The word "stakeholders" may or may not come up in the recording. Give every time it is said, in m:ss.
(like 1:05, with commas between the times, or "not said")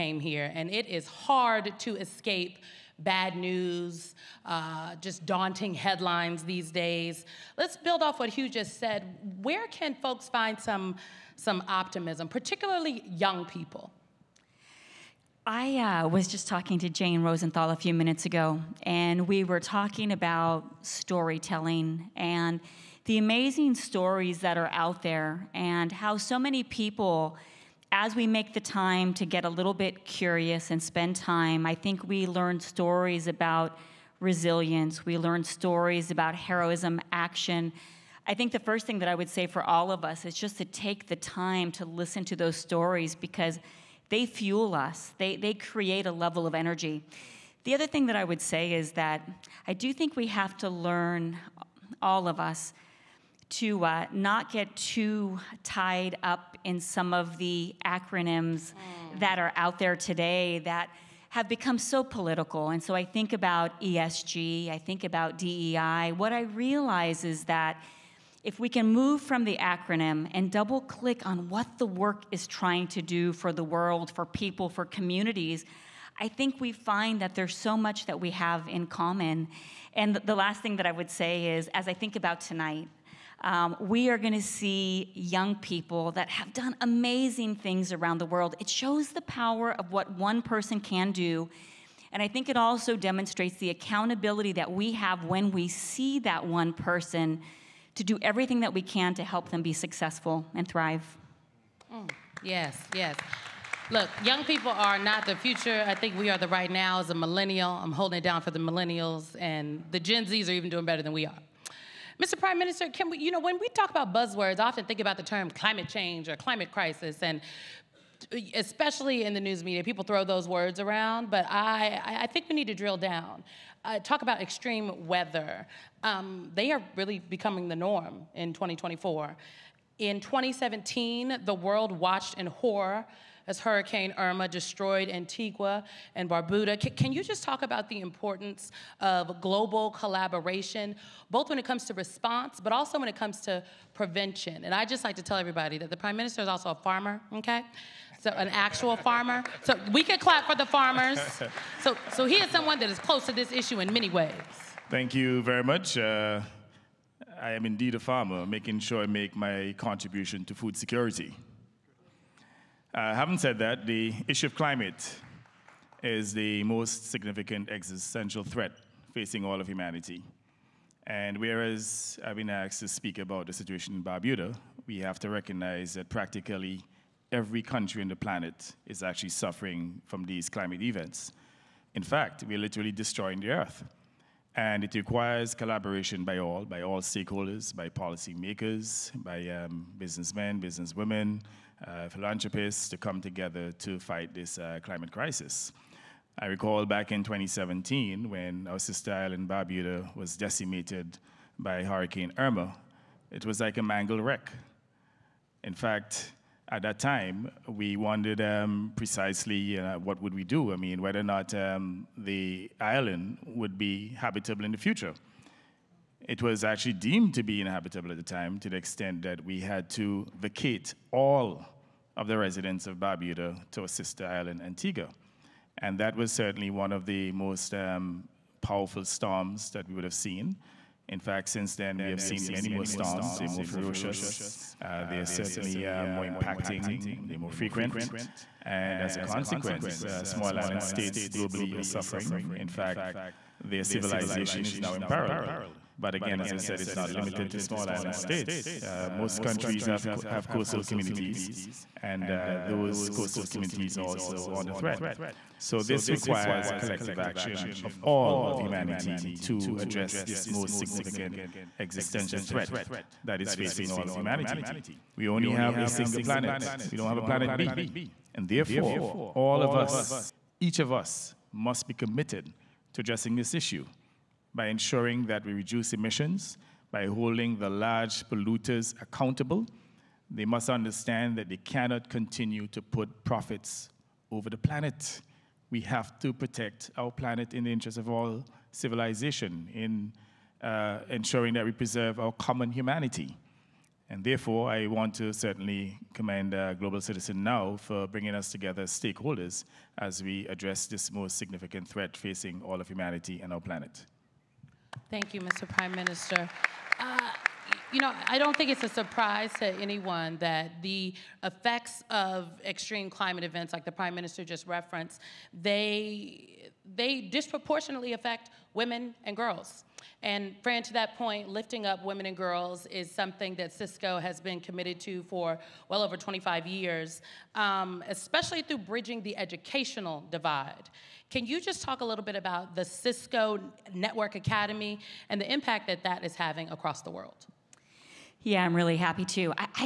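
3:07, 4:58.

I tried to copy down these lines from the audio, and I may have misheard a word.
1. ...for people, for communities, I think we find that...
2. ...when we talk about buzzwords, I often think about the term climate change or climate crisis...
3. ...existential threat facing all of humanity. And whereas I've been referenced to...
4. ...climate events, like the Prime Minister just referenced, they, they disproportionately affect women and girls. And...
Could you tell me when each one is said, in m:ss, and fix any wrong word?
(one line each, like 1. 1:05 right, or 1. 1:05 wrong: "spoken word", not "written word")
1. 1:14 right
2. 1:53 right
3. 2:47 wrong: "asked", not "referenced"
4. 5:13 right.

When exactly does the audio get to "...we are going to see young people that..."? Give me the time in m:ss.
1:23.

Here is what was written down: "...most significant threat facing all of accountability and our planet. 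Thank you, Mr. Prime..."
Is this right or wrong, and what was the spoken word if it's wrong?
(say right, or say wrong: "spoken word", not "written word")
wrong: "humanity", not "accountability".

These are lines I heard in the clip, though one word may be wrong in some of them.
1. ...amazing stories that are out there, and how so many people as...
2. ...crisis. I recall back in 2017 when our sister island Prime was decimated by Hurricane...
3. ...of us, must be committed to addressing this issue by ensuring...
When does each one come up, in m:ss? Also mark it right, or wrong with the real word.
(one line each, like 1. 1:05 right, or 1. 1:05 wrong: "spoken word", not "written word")
1. 0:23 right
2. 3:15 wrong: "Barbuda", not "Prime"
3. 4:30 right.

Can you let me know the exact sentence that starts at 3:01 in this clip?
In fact, we're literally destroying the earth.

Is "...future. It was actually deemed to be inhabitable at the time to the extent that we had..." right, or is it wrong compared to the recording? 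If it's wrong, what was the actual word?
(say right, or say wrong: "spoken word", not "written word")
right.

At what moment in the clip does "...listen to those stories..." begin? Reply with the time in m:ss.
0:41.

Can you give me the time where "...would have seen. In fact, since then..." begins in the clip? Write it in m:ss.
3:49.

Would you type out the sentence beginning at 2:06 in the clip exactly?
Um, they are really becoming the norm in 2024.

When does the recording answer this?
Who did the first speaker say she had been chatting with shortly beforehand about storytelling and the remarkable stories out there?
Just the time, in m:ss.
0:16.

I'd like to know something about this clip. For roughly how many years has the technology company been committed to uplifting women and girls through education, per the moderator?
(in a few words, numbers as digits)
25 years.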